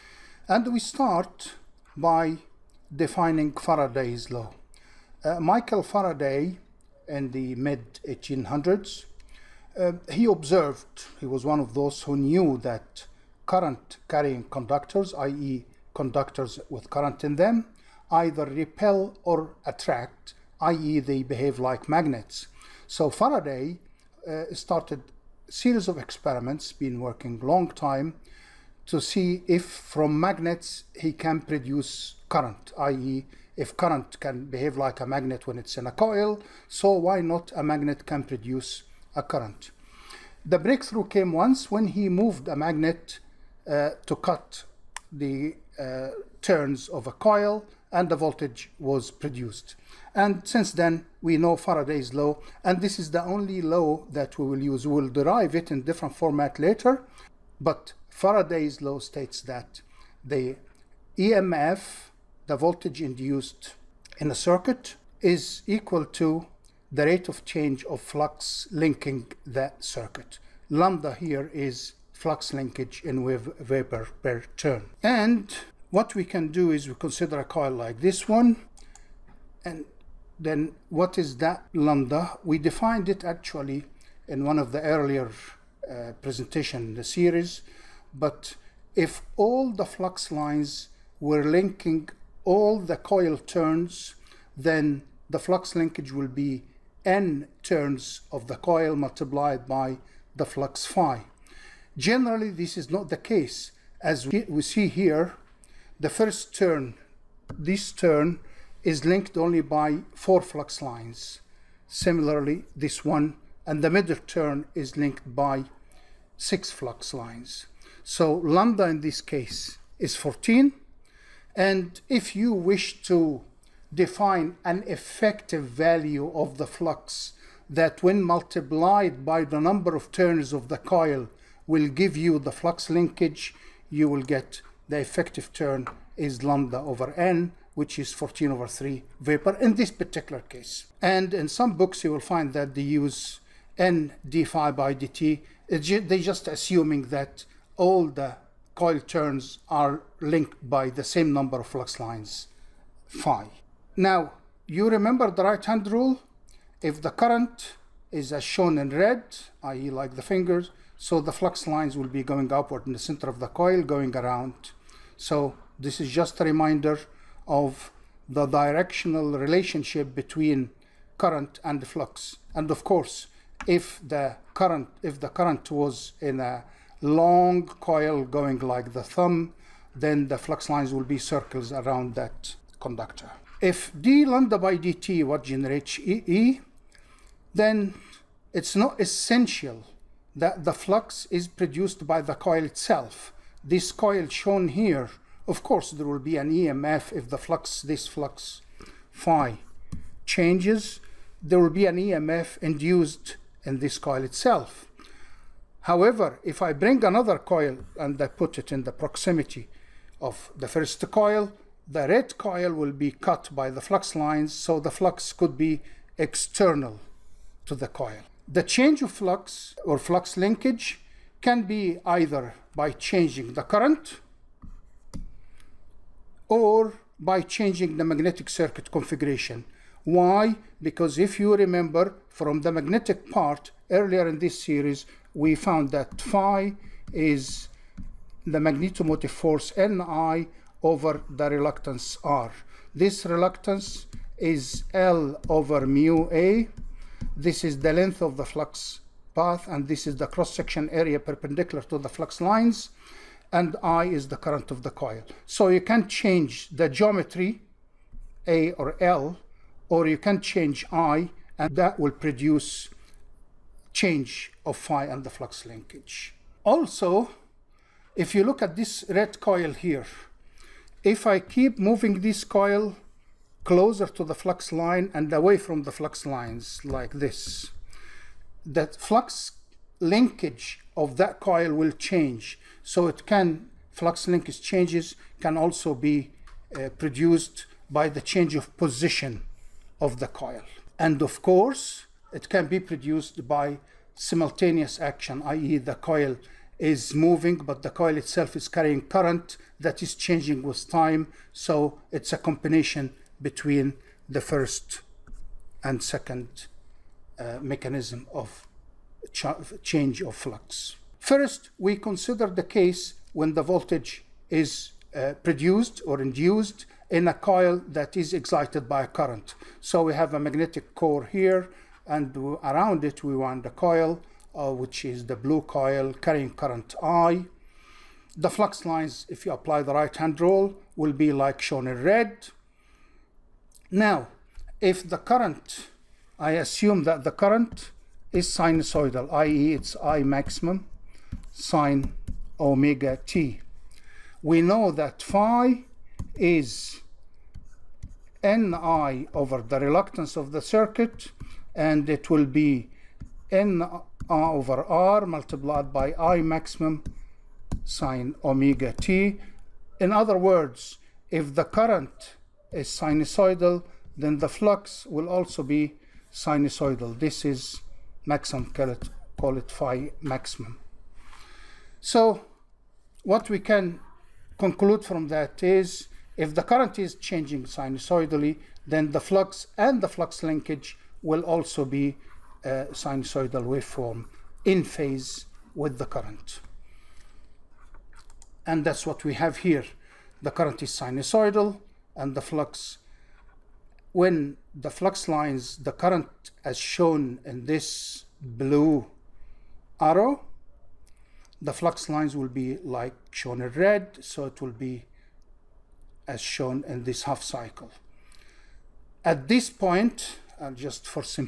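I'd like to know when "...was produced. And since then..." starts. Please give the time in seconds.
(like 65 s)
48 s.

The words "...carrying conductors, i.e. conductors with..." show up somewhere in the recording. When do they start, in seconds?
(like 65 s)
14 s.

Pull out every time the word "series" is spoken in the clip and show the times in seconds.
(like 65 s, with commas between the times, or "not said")
25 s, 87 s, 234 s.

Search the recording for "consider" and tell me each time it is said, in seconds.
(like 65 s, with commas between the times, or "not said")
76 s, 311 s.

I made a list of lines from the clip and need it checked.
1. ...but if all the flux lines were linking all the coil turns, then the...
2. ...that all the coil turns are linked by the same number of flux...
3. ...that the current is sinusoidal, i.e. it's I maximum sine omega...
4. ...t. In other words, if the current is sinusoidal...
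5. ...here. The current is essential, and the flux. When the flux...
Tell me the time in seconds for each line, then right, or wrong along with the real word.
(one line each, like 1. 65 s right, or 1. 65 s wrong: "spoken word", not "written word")
1. 88 s right
2. 147 s right
3. 337 s right
4. 358 s right
5. 389 s wrong: "sinusoidal", not "essential".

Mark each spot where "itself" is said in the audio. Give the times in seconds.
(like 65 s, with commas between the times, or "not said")
192 s, 204 s, 298 s.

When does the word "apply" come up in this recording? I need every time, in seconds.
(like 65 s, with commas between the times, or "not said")
329 s.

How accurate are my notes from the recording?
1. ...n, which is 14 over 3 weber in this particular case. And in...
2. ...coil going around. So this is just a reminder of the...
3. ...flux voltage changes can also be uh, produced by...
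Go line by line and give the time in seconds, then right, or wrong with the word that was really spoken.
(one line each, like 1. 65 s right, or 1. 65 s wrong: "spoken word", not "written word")
1. 137 s right
2. 163 s right
3. 283 s wrong: "linkage", not "voltage".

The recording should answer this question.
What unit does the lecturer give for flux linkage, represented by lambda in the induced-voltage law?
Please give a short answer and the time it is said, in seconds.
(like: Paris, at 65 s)
weber per turn, at 73 s.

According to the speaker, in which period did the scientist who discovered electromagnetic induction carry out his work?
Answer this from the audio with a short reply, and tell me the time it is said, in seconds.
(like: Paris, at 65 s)
mid 1800s, at 7 s.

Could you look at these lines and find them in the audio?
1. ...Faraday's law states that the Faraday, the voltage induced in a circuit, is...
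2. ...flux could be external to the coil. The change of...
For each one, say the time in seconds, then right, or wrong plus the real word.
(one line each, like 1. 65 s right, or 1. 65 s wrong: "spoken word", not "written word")
1. 58 s wrong: "EMF", not "Faraday"
2. 214 s right.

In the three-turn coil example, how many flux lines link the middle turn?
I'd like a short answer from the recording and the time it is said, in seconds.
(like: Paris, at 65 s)
6, at 116 s.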